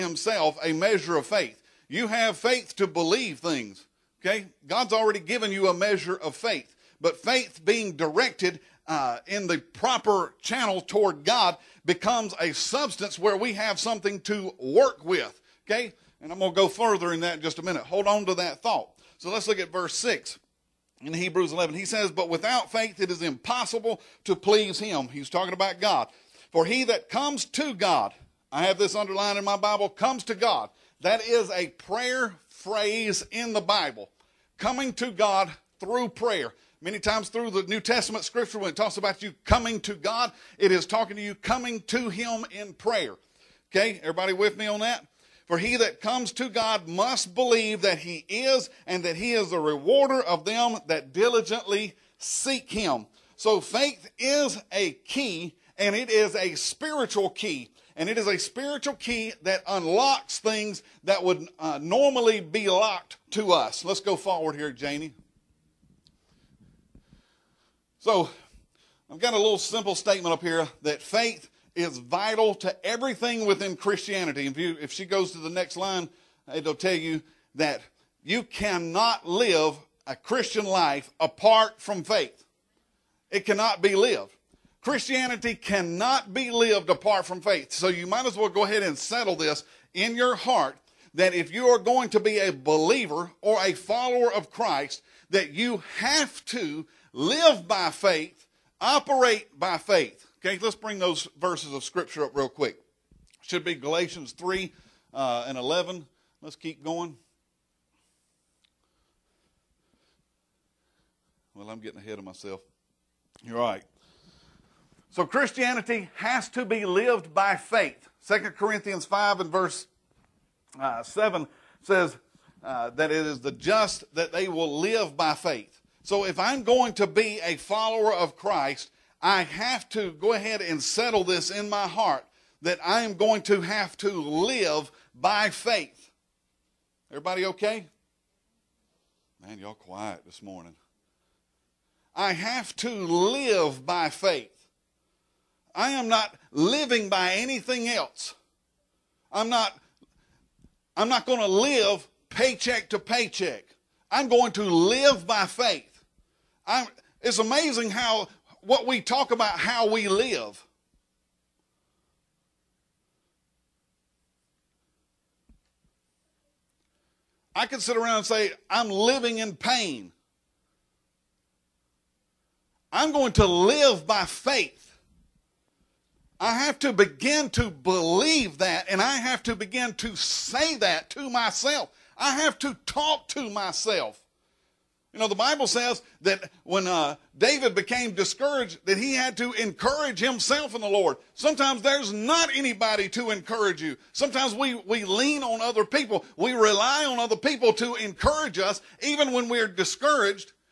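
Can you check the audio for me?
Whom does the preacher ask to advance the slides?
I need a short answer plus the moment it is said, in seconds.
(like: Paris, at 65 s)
Janie, at 64 s.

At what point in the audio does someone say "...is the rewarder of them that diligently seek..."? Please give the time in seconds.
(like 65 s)
49 s.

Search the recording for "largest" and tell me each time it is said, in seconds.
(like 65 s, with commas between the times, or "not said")
not said.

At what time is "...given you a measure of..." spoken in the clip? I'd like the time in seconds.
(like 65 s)
5 s.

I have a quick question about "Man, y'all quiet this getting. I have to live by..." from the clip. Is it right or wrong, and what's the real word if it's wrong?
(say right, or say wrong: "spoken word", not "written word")
wrong: "morning", not "getting".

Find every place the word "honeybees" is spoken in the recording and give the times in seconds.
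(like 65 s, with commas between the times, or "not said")
not said.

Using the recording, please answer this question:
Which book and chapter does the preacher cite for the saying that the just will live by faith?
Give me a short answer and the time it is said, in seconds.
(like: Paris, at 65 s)
2 Corinthians 5, at 118 s.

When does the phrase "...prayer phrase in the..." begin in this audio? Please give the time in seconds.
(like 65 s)
31 s.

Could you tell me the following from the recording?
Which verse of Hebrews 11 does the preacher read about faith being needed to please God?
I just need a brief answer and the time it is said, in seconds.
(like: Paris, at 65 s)
Verse 6, at 19 s.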